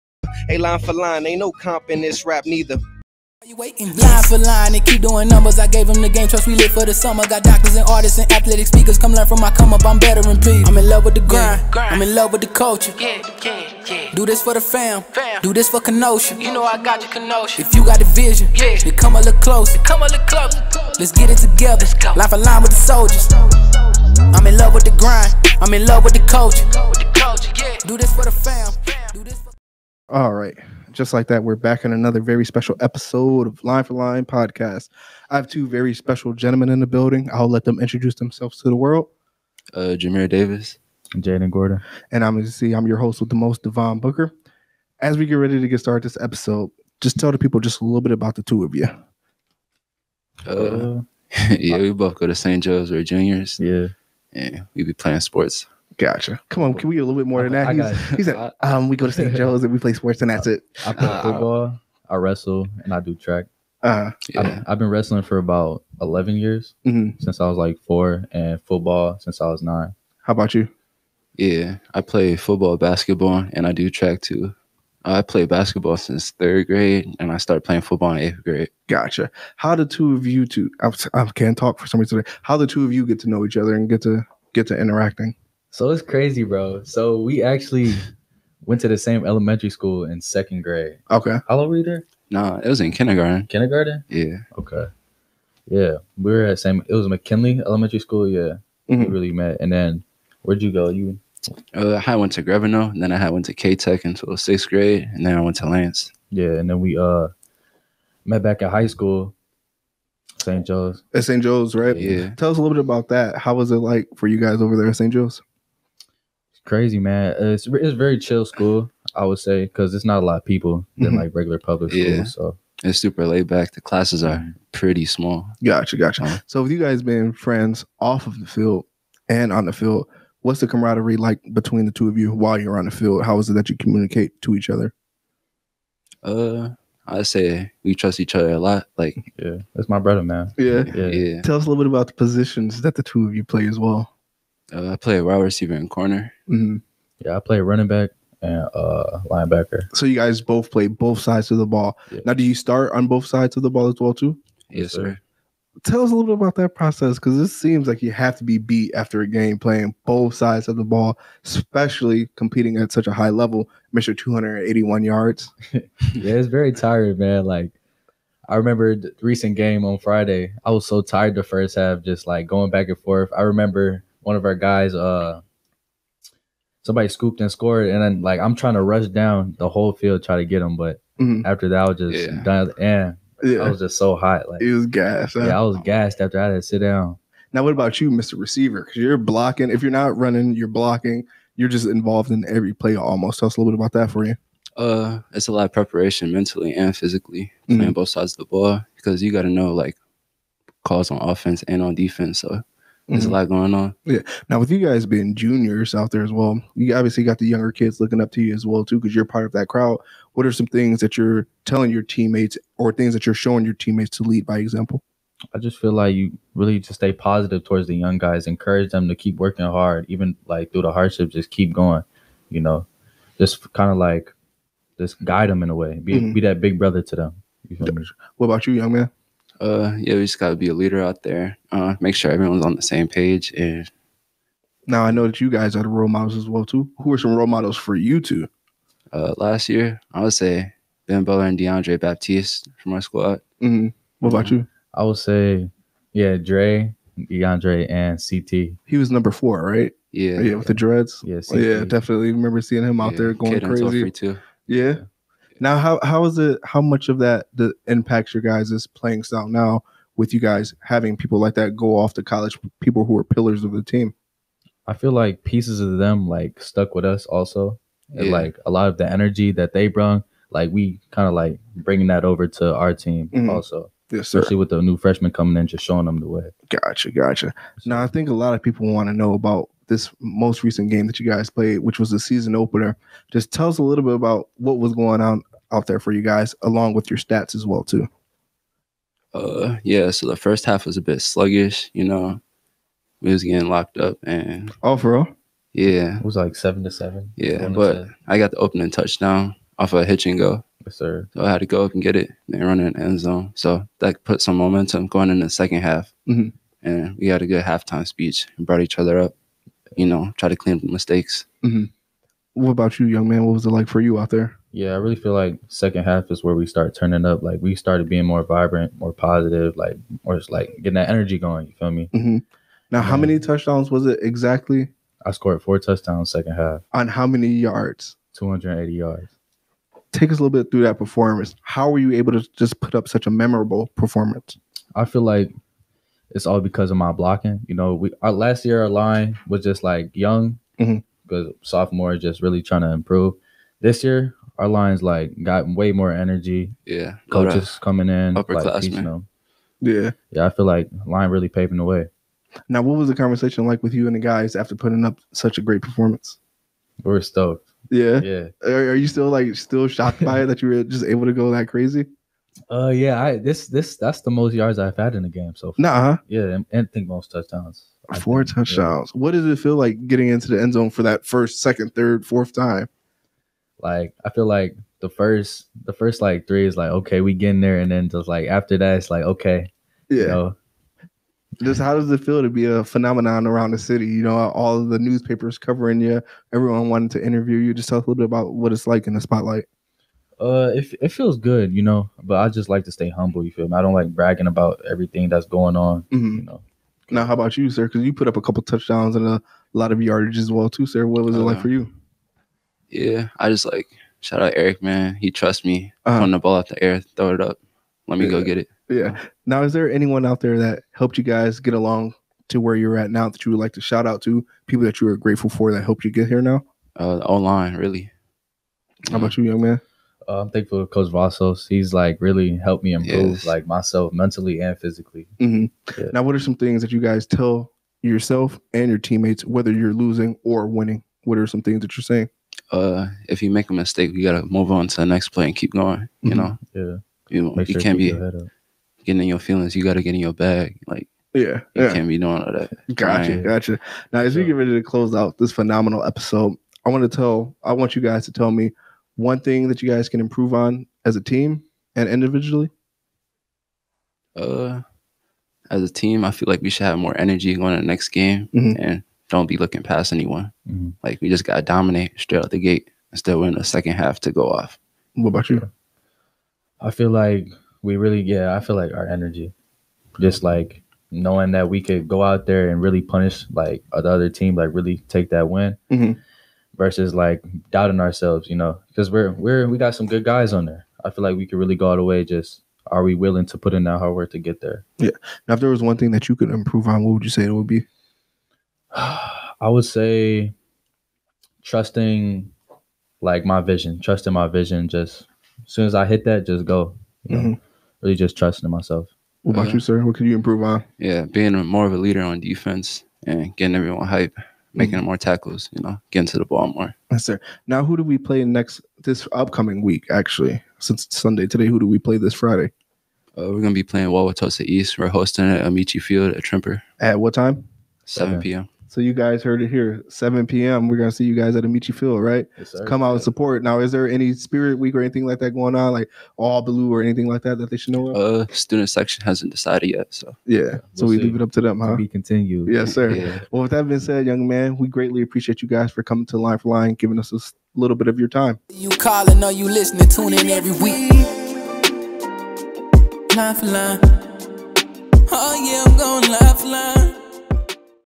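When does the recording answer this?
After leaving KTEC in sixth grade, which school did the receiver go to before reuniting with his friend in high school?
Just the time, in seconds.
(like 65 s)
105 s.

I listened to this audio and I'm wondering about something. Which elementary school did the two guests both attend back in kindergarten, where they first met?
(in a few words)
McKinley Elementary School.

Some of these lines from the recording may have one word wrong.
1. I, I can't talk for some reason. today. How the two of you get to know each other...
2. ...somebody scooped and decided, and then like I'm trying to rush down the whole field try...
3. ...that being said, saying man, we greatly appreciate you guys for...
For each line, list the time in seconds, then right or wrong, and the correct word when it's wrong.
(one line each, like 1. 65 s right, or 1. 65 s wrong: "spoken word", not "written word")
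1. 80 s right
2. 176 s wrong: "scored", not "decided"
3. 533 s wrong: "young", not "saying".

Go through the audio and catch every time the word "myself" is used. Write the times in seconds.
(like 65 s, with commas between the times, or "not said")
423 s, 498 s.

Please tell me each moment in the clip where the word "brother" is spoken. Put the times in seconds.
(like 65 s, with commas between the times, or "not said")
139 s, 226 s.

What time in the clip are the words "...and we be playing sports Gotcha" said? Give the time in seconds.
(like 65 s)
54 s.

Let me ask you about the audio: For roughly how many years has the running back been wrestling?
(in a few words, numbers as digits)
11.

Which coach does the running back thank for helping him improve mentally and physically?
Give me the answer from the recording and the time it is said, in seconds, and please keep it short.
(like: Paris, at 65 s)
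Coach Vassos, at 420 s.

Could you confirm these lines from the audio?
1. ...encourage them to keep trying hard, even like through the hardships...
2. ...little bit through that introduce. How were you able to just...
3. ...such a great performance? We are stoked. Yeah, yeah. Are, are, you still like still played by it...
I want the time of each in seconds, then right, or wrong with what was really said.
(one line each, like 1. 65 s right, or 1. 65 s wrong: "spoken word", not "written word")
1. 218 s wrong: "working", not "trying"
2. 330 s wrong: "performance", not "introduce"
3. 355 s wrong: "shocked", not "played".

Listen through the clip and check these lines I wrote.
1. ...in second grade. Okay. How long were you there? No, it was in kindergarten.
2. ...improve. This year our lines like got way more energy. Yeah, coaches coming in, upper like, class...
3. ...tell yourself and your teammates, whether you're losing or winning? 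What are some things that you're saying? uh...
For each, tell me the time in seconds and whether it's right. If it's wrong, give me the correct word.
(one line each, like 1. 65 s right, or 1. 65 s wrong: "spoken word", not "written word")
1. 90 s right
2. 342 s right
3. 427 s right.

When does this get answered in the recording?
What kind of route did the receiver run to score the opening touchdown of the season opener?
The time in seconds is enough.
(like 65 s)
300 s.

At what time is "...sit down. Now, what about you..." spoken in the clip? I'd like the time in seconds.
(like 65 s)
186 s.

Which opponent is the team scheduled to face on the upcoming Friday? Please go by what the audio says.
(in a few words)
Wauwatosa East.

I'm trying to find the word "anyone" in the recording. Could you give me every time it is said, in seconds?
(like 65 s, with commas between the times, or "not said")
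409 s, 460 s.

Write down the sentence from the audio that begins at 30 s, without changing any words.
Just like that, we're back in another very special episode of Line for Line podcast.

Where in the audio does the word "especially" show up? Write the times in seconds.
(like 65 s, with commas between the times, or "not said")
161 s, 274 s.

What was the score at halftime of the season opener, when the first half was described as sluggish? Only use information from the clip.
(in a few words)
7 to 7.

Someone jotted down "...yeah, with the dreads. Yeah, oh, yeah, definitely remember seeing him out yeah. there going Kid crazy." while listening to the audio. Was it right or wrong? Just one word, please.
right.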